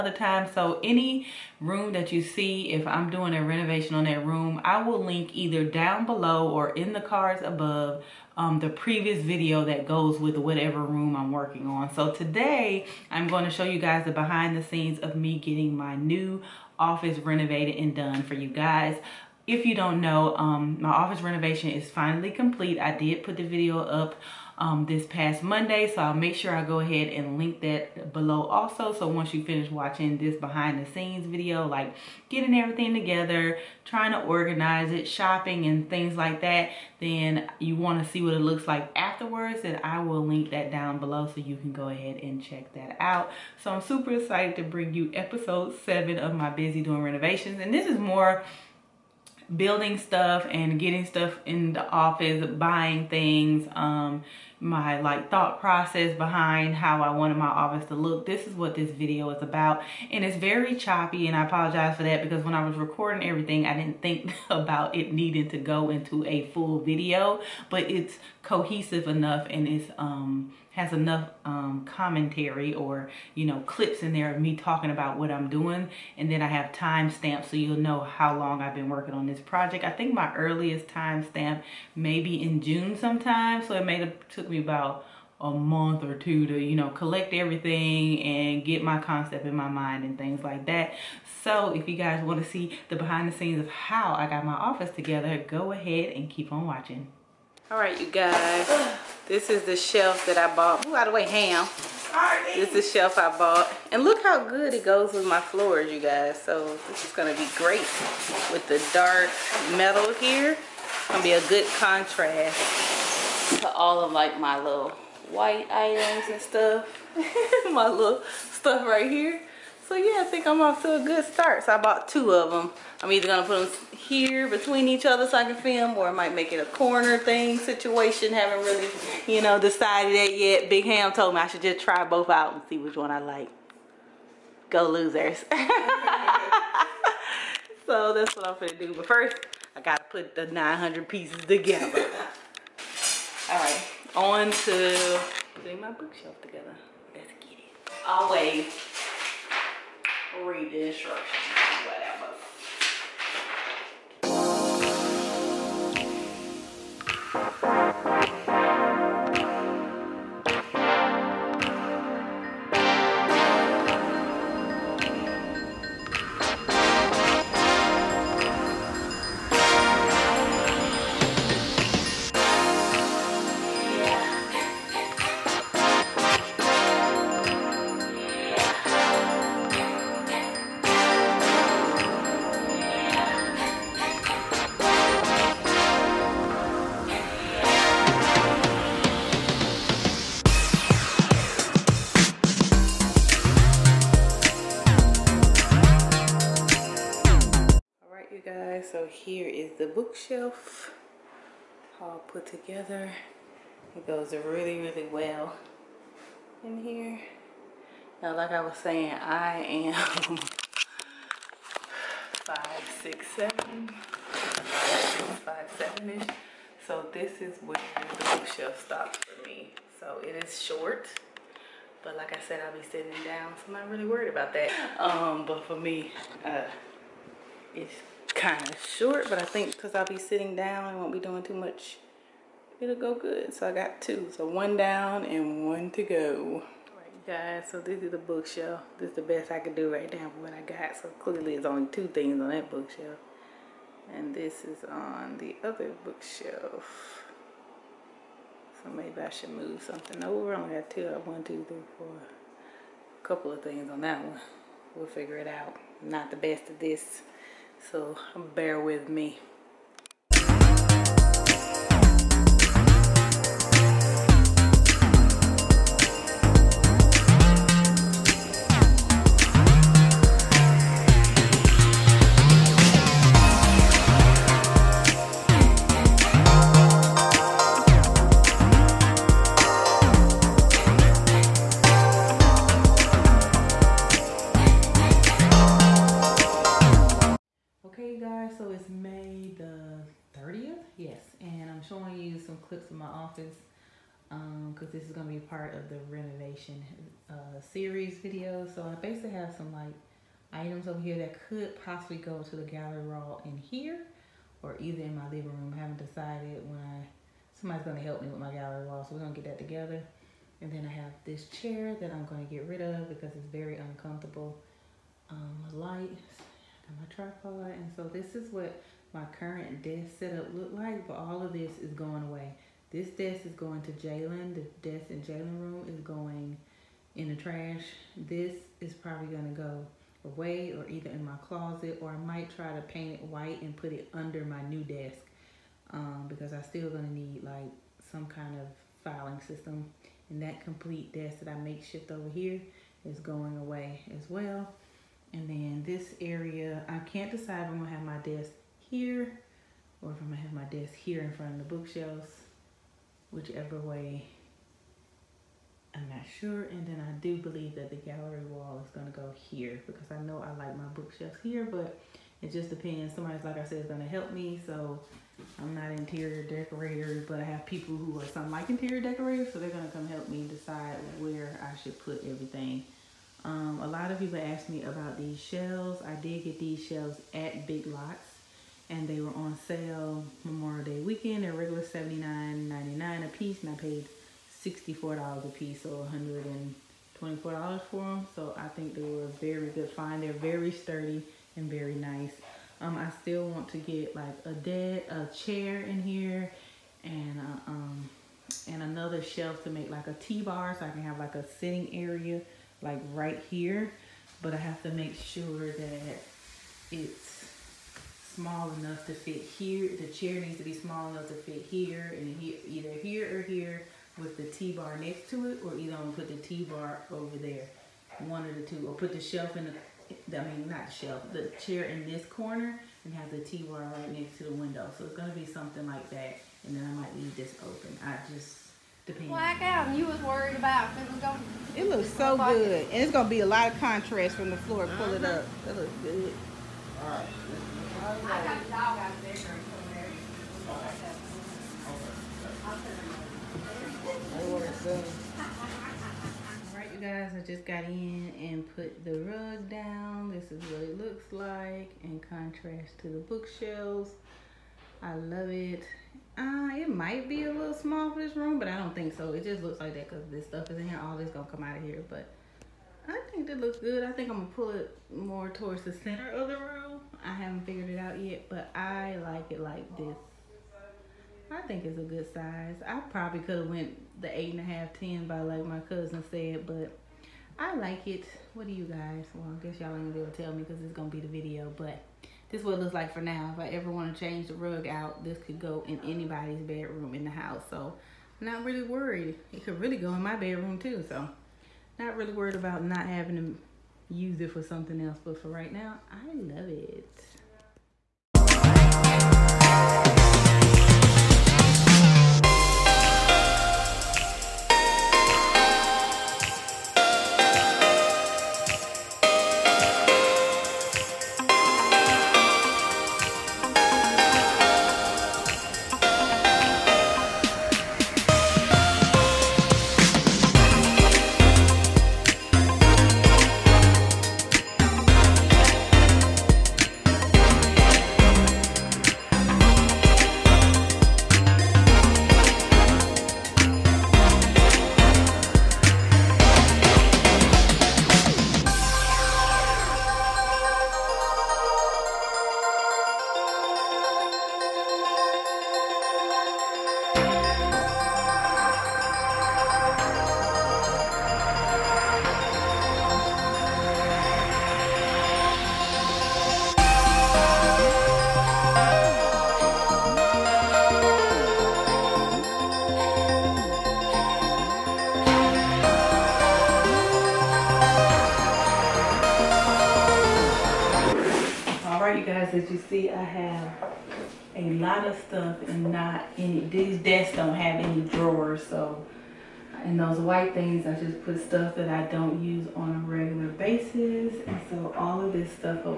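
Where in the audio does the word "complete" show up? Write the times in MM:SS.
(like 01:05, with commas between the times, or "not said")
00:22, 05:40.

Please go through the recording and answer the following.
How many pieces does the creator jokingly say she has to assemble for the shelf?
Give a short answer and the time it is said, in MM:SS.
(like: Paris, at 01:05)
900, at 02:20.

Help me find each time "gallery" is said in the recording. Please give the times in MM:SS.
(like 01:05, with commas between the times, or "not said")
05:02, 05:08, 05:57.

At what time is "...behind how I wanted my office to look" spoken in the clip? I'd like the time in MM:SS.
00:56.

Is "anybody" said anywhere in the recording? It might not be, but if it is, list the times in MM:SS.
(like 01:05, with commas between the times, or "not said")
08:06.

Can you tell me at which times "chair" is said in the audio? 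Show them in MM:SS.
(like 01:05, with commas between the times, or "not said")
05:11, 06:35, 06:50, 07:01.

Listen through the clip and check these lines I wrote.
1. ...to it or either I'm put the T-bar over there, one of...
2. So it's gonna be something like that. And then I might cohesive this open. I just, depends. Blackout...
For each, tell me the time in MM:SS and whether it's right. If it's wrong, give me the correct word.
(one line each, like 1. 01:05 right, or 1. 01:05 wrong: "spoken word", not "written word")
1. 06:55 right
2. 07:04 wrong: "leave", not "cohesive".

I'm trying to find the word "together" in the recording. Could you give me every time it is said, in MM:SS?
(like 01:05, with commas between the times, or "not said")
00:32, 01:34, 02:21, 02:26, 03:22, 05:09.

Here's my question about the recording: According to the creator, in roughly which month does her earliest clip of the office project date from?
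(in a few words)
June.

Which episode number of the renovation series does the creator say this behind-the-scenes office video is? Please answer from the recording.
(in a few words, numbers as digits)
7.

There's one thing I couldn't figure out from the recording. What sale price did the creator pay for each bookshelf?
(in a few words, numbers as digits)
$64.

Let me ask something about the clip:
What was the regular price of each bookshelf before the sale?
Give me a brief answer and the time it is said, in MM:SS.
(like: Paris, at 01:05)
$79.99, at 06:21.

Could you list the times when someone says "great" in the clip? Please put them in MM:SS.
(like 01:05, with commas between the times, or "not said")
01:47.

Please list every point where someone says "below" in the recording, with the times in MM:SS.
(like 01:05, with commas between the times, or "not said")
00:06, 00:28, 00:40.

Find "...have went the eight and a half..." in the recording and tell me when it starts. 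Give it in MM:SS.
07:53.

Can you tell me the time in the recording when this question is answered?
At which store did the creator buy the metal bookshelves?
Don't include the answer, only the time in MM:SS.
06:17.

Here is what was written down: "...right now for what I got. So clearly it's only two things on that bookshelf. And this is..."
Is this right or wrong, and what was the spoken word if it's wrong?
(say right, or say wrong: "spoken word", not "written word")
right.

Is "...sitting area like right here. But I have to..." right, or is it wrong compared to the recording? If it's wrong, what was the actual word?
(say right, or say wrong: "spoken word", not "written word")
right.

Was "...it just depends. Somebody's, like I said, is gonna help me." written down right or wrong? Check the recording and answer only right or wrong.
right.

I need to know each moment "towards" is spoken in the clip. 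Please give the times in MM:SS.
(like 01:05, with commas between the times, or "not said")
07:45.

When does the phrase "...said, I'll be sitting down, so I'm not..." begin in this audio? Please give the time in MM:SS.
03:42.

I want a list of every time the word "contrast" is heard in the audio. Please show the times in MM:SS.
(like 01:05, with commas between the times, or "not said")
01:51, 07:13, 07:32.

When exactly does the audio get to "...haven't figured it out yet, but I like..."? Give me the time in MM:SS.
07:47.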